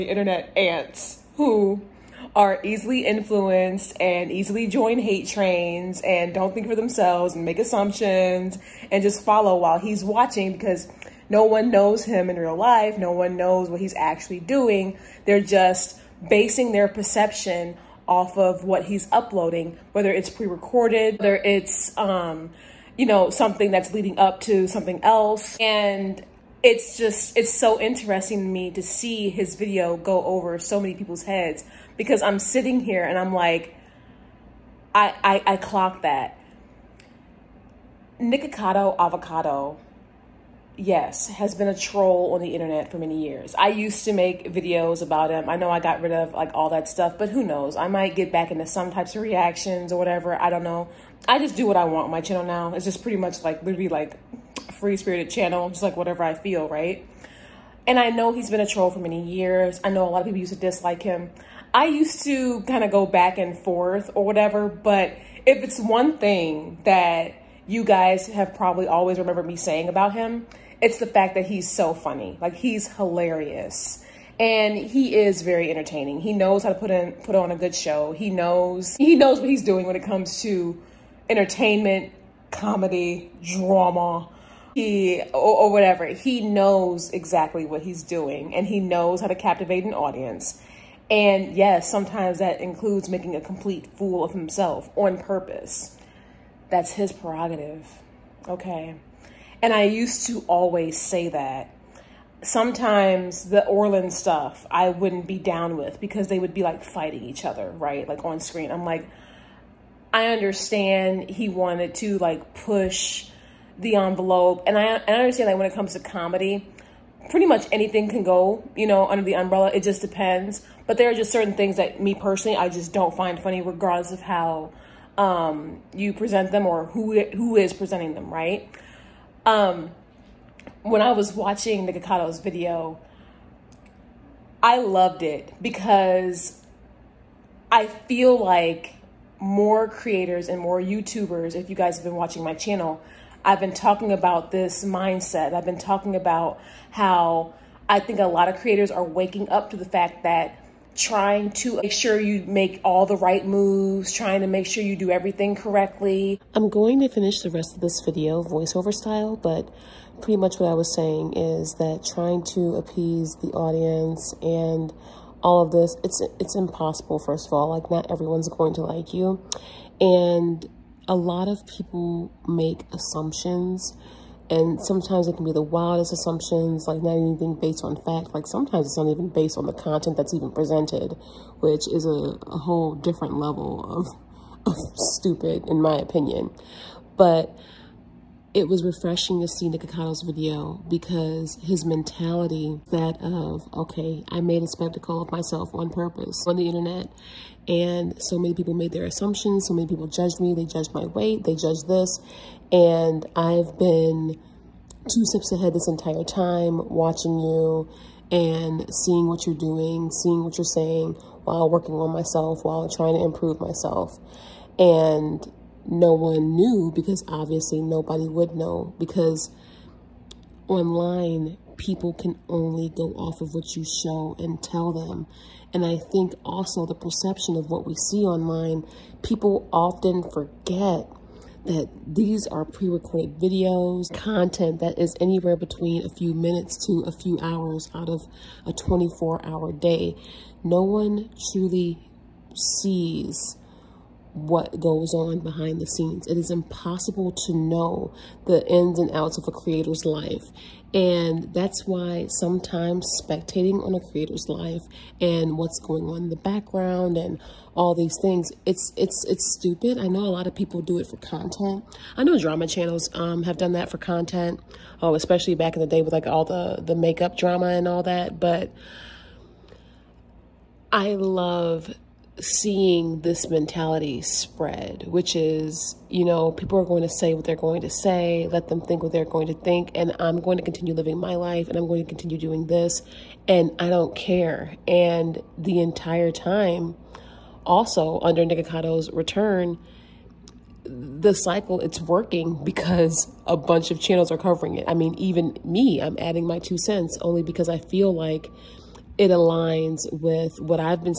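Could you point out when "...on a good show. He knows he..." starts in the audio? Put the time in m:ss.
1:17.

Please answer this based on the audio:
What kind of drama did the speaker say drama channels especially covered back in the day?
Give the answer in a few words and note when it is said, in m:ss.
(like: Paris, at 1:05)
makeup drama, at 4:26.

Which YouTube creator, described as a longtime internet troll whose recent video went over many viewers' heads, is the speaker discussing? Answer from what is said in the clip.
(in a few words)
Nikocado Avocado.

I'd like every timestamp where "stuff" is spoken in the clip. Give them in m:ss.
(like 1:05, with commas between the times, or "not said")
0:46, 1:44.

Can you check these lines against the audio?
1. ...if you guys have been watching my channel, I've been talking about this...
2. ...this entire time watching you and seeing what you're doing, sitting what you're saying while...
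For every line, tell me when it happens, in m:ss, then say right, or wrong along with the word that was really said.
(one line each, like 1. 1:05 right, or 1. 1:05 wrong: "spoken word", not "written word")
1. 2:21 right
2. 3:25 wrong: "seeing", not "sitting".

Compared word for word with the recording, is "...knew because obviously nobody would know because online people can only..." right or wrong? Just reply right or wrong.
right.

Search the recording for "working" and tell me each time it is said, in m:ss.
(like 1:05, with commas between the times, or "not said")
3:31, 4:51.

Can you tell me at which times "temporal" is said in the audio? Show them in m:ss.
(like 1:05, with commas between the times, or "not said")
not said.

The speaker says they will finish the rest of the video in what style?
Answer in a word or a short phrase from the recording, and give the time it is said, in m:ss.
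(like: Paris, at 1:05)
voiceover style, at 2:38.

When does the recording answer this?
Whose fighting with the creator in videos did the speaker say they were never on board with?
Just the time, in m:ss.
1:43.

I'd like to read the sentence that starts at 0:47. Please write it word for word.
I might get back into some types of reactions or whatever.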